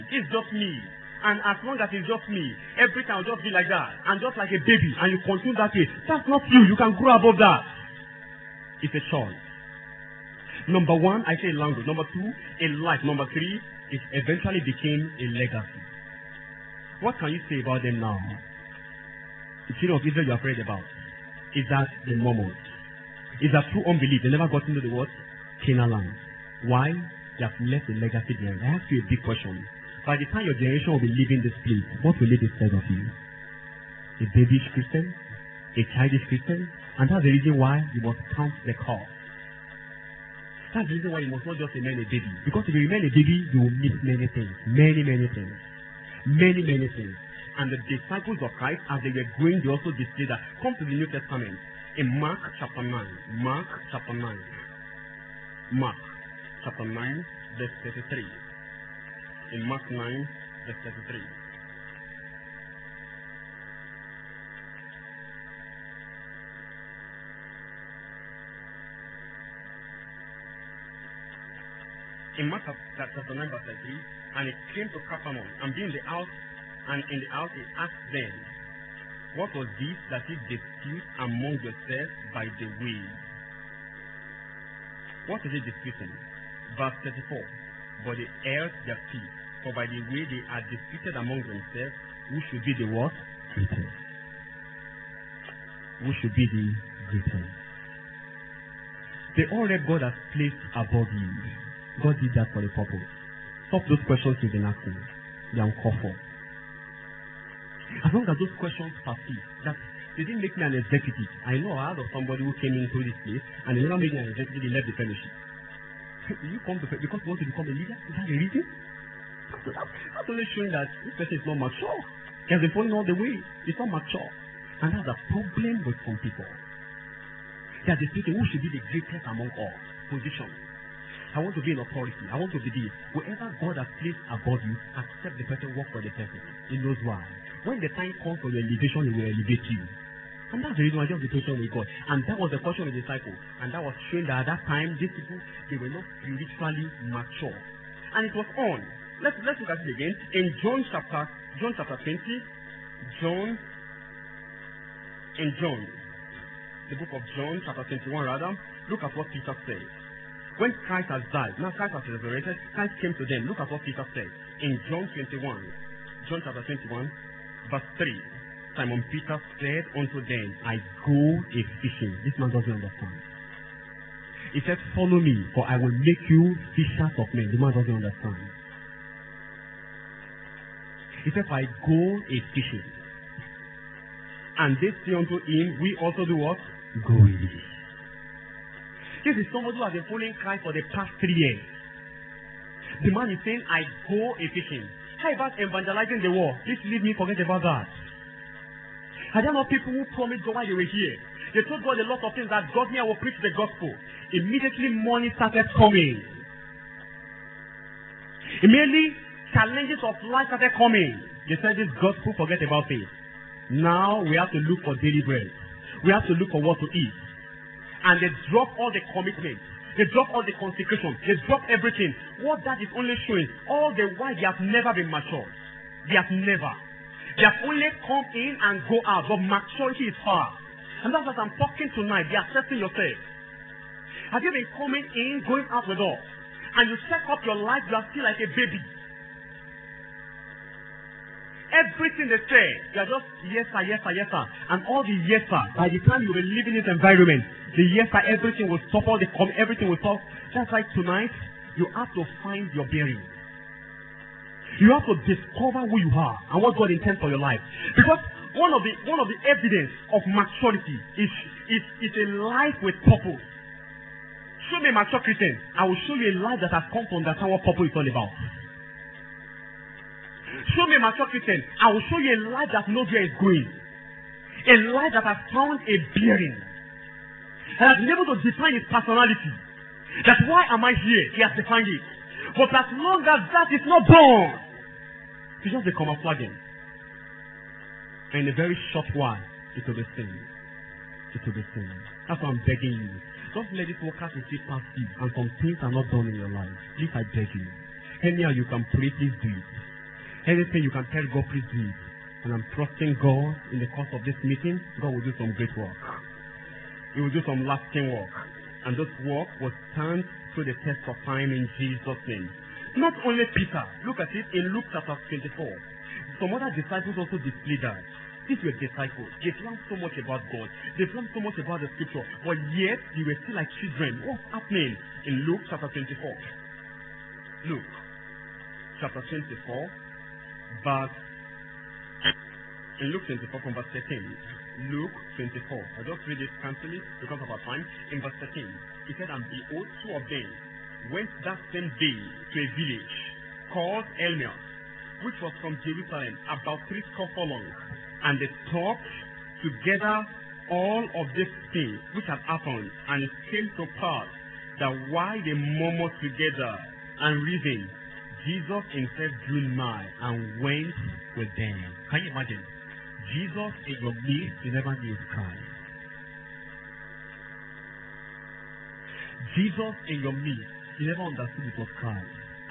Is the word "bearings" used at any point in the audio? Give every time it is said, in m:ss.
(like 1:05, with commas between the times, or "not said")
4:12, 4:36.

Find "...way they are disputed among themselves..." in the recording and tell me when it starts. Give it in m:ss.
1:30.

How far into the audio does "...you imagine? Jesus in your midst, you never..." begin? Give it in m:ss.
6:02.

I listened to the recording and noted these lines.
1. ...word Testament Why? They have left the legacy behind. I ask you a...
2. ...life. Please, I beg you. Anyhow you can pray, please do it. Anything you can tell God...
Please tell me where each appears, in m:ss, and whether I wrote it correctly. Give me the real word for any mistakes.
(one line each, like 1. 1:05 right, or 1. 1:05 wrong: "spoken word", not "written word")
1. 0:24 wrong: "Canaan", not "Testament"
2. 4:56 right.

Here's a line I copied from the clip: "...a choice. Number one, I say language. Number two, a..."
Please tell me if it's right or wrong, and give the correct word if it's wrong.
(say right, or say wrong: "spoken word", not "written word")
right.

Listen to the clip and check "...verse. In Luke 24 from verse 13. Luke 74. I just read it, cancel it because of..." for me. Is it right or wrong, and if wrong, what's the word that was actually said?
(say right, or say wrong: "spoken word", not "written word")
wrong: "24", not "74".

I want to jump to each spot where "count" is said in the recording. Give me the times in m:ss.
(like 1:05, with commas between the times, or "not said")
0:38.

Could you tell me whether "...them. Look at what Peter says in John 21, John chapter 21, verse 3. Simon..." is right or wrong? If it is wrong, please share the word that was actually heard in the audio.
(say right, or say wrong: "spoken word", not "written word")
right.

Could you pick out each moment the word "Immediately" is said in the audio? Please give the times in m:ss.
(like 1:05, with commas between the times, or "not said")
3:24, 3:28.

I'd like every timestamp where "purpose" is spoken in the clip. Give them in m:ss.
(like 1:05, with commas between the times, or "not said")
1:42, 4:23, 4:27.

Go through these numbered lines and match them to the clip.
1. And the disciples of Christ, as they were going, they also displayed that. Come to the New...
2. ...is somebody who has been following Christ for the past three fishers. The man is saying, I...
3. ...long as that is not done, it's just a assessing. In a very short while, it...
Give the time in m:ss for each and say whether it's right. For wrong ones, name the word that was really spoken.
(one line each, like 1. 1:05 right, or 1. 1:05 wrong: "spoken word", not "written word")
1. 0:47 right
2. 3:09 wrong: "years", not "fishers"
3. 4:42 wrong: "camouflaging", not "assessing".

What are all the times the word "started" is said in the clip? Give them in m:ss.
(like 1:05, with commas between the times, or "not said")
3:25, 3:30.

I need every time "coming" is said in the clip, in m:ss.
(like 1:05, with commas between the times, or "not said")
3:25, 3:30, 3:54.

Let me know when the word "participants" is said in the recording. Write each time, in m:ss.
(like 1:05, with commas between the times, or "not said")
not said.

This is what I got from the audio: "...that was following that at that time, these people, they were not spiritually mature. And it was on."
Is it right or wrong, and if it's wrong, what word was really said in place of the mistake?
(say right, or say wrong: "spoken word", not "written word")
wrong: "showing", not "following".